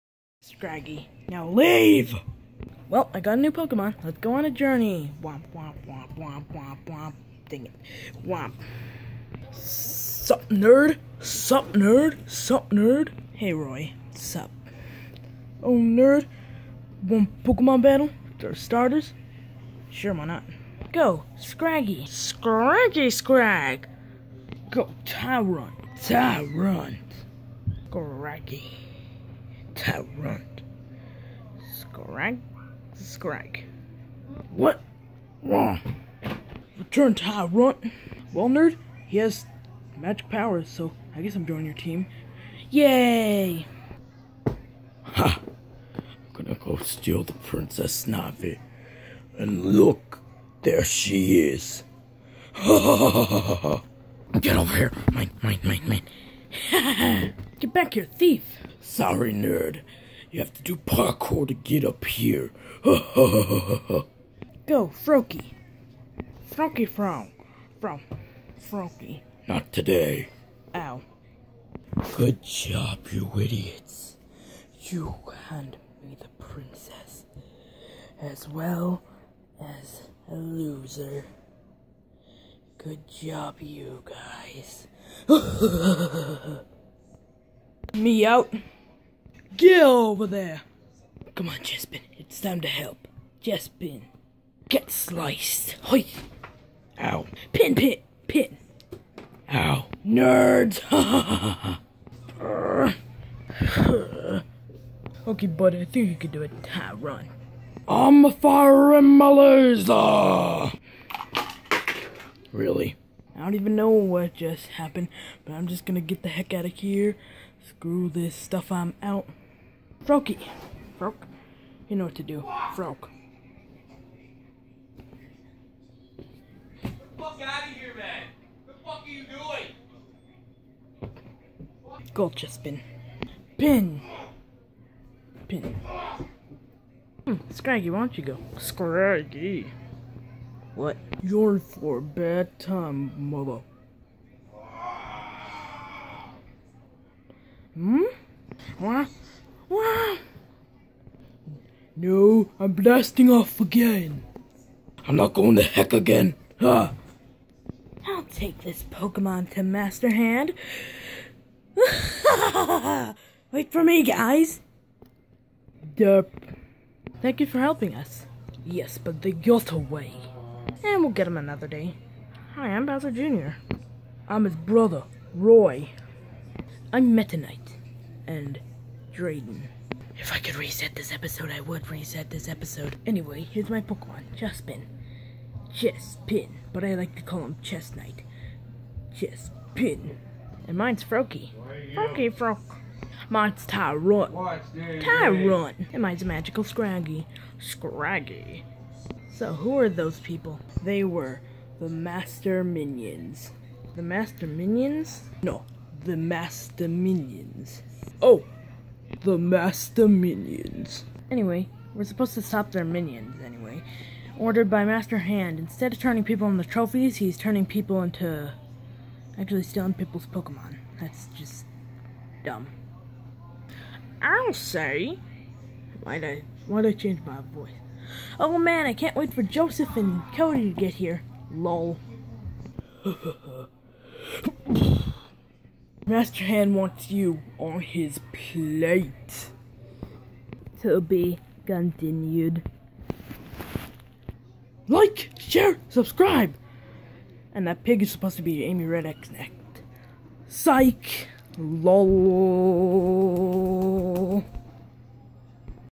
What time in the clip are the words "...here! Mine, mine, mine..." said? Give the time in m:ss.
0:54.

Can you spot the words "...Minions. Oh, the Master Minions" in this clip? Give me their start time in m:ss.
3:26.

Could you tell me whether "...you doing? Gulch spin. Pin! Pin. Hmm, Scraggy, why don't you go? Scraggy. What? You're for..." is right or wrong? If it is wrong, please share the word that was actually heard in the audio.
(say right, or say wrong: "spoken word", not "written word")
right.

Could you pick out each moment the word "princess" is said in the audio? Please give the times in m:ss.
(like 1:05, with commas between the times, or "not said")
0:47, 1:16.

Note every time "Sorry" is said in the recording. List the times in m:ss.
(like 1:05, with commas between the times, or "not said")
0:58.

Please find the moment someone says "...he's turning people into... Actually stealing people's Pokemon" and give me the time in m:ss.
3:37.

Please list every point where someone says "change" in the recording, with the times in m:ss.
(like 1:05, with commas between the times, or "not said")
3:46.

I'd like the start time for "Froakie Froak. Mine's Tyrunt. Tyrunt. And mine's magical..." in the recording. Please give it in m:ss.
3:11.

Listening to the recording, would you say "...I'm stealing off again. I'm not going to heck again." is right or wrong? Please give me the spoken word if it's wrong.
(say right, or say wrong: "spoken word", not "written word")
wrong: "blasting", not "stealing".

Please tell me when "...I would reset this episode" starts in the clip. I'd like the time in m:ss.
3:01.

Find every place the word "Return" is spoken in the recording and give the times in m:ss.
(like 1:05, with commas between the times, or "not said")
0:36.